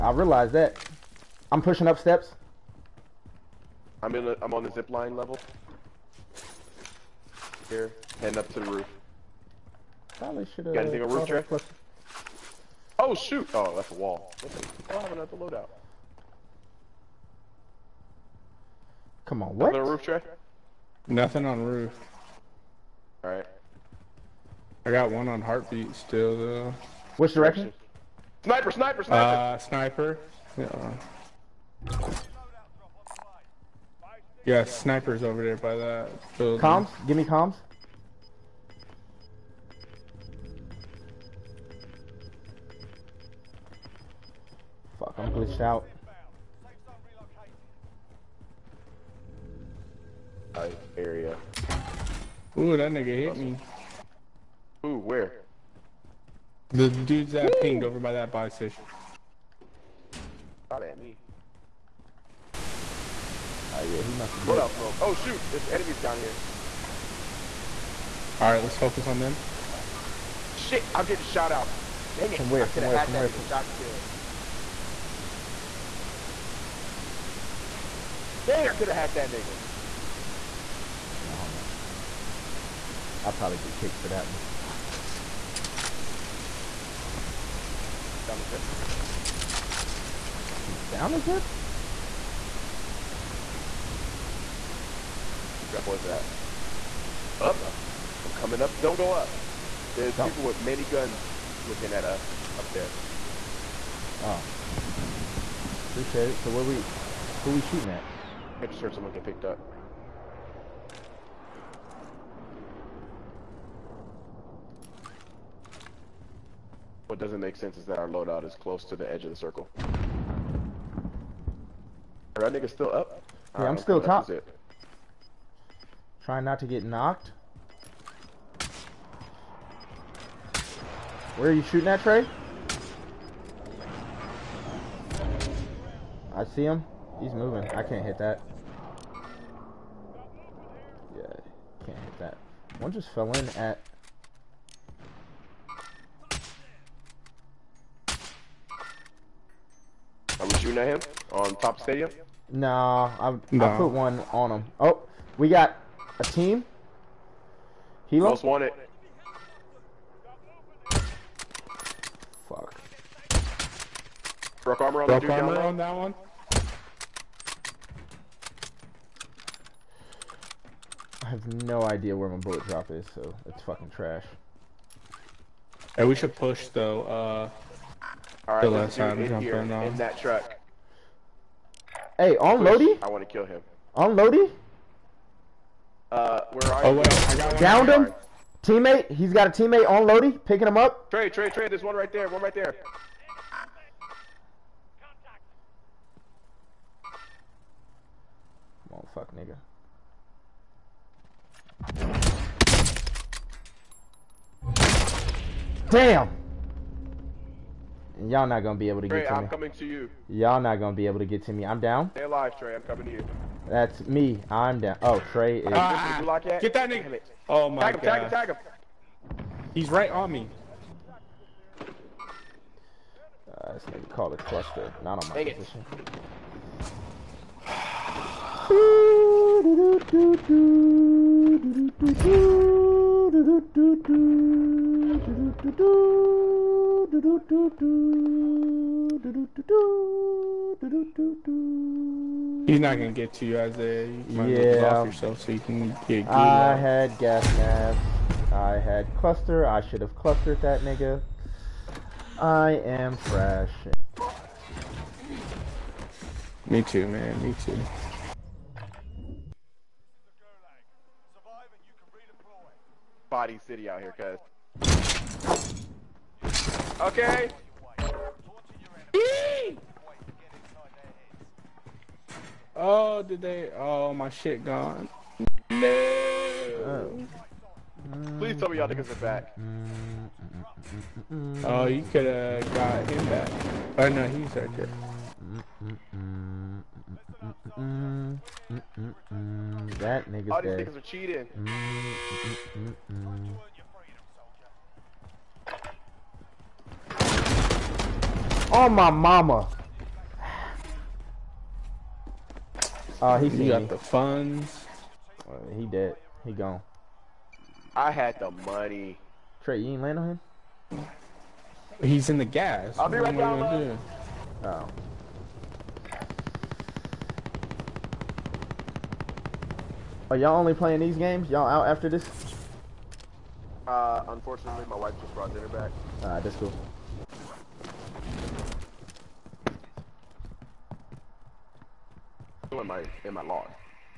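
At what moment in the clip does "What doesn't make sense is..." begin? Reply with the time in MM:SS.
01:57.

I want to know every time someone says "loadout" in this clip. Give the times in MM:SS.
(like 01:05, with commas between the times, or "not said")
00:15, 01:58.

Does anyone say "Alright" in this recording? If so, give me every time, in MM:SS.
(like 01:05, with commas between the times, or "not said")
00:23, 01:03, 01:08, 05:26.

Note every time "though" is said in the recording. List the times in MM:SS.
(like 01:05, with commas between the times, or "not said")
00:26, 02:56.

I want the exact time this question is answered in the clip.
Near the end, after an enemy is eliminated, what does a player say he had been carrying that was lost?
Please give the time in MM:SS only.
05:07.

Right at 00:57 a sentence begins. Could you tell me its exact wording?
pinged over by that buy station.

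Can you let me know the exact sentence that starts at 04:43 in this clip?
But oh, no, he's right there.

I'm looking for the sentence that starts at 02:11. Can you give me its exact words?
Where are you shooting at, Trey?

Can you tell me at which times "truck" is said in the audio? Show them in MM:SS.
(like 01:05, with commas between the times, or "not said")
03:00.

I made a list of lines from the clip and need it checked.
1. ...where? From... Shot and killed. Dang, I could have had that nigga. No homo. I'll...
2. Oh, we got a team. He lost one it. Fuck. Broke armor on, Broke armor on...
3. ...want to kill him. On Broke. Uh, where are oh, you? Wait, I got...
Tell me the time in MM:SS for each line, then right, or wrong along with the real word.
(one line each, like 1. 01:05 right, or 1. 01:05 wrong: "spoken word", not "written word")
1. 01:13 right
2. 02:34 right
3. 03:03 wrong: "Lodi", not "Broke".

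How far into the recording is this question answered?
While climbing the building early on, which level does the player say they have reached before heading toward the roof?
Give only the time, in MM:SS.
00:04.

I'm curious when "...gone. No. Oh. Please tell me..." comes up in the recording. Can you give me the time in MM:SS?
04:34.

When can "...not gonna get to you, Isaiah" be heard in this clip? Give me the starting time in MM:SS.
04:02.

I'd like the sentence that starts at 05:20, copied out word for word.
Are y'all only playing these games?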